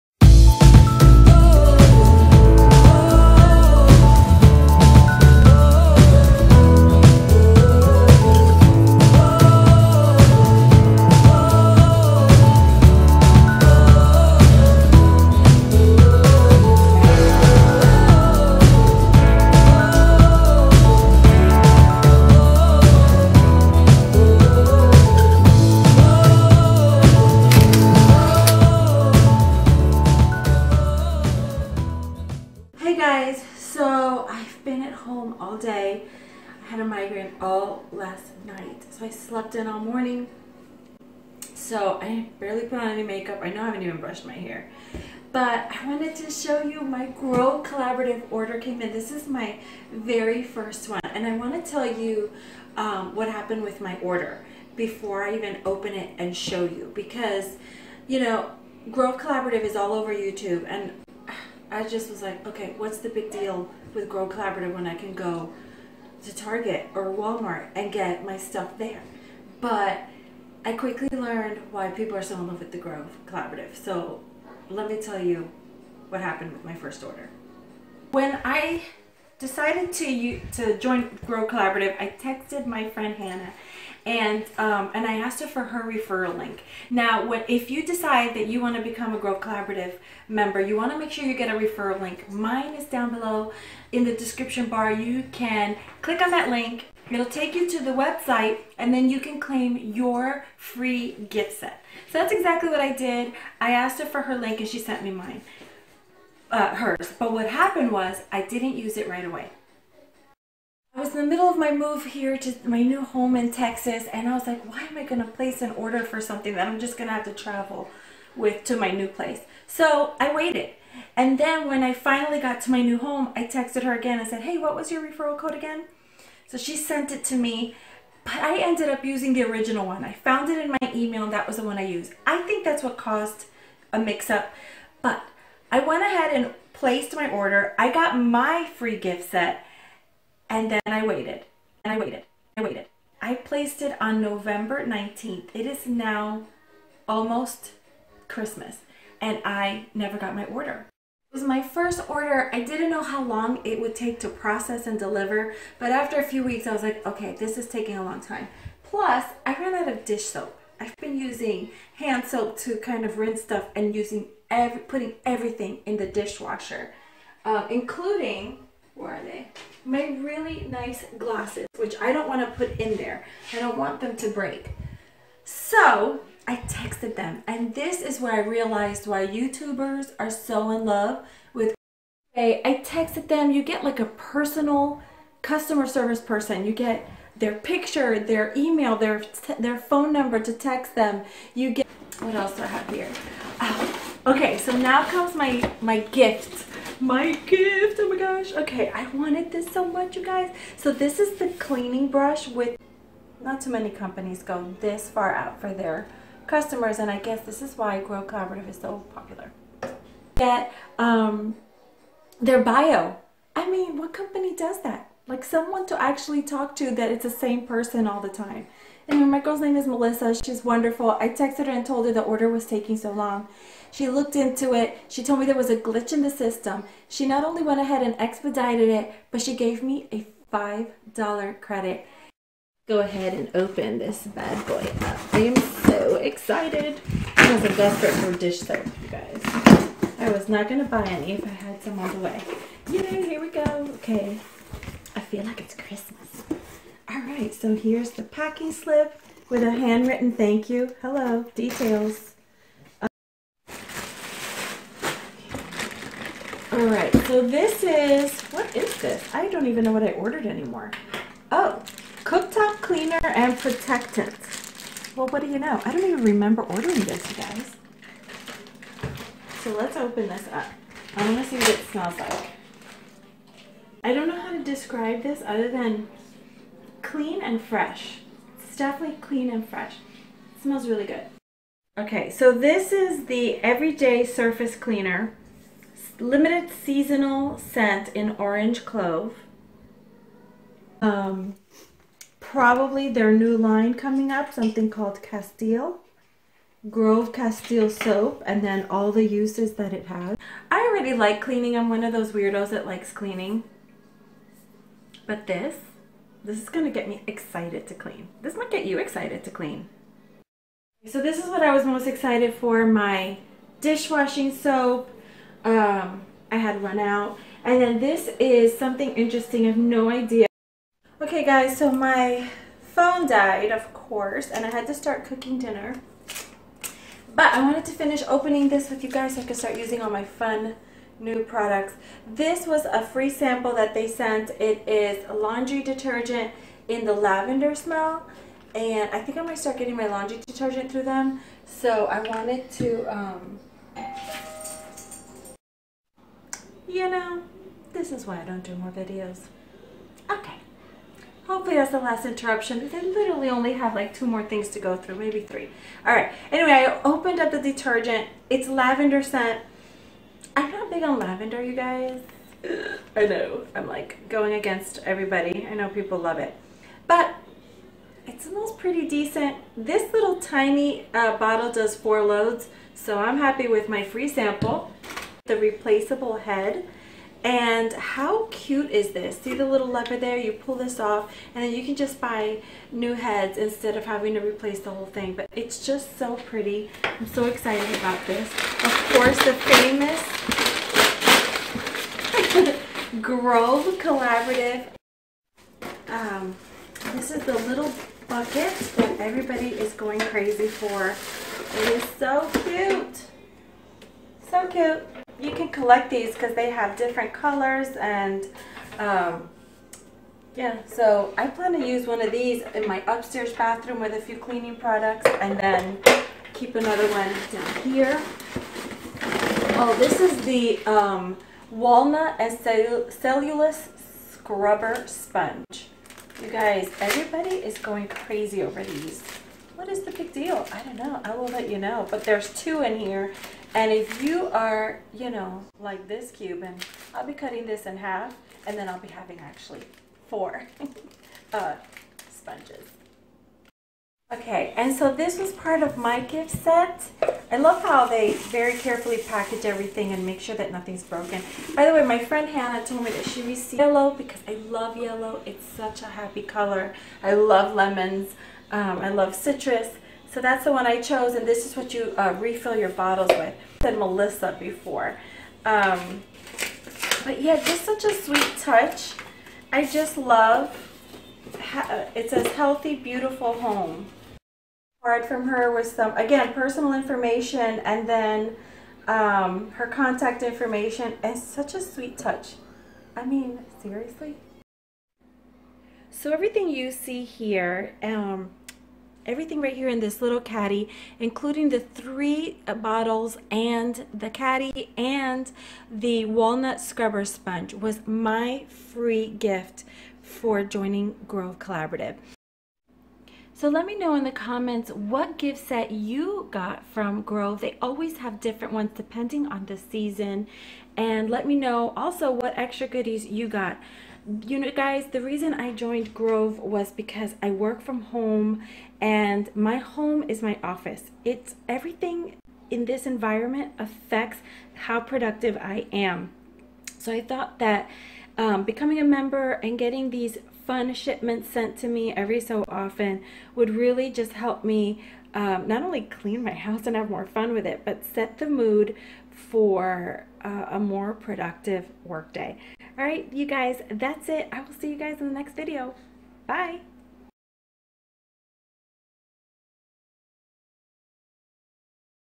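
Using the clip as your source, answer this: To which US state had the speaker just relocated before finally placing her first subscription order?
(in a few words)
Texas.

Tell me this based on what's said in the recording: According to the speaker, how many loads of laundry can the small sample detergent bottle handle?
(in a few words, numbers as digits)
4.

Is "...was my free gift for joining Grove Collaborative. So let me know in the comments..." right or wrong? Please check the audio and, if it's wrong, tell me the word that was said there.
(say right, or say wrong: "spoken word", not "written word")
right.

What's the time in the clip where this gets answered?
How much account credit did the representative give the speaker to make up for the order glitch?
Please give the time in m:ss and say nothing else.
3:50.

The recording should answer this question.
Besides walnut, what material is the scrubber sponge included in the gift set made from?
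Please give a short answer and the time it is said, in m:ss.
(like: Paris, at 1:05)
cellulose, at 7:03.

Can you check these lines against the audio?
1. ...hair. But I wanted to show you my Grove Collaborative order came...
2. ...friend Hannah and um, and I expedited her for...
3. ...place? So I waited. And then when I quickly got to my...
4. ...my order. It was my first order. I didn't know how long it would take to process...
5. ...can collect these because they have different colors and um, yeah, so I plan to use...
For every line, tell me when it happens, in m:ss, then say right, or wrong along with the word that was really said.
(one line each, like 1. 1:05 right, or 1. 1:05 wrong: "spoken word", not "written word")
1. 0:44 right
2. 1:22 wrong: "asked", not "expedited"
3. 1:59 wrong: "finally", not "quickly"
4. 2:30 right
5. 6:45 right.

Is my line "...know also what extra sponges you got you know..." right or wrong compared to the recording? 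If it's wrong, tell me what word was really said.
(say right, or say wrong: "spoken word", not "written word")
wrong: "goodies", not "sponges".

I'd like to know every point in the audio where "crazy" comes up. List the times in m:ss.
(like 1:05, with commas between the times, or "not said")
6:40, 7:08.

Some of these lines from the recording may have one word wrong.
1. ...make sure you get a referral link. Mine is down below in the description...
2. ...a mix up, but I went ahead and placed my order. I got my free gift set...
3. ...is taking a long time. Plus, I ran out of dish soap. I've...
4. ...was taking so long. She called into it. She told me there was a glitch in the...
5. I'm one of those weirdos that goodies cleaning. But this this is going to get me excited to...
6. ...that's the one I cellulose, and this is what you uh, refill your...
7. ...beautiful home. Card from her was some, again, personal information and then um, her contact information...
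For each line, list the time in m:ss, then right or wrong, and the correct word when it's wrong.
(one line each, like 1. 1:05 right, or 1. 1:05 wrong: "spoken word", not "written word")
1. 1:30 right
2. 2:13 right
3. 2:37 right
4. 3:42 wrong: "looked", not "called"
5. 5:01 wrong: "likes", not "goodies"
6. 7:40 wrong: "chose", not "cellulose"
7. 7:52 right.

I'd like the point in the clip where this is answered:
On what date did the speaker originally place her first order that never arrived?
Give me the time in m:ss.
2:24.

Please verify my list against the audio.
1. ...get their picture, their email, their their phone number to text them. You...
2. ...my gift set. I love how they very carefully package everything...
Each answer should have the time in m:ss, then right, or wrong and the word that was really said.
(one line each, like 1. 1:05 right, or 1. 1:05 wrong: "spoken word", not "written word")
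1. 3:06 right
2. 7:25 right.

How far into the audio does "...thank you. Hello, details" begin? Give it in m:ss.
4:10.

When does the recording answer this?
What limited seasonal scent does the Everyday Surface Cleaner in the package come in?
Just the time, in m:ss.
4:48.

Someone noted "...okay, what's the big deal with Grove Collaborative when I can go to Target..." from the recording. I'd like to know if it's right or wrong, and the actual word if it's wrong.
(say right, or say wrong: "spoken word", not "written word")
right.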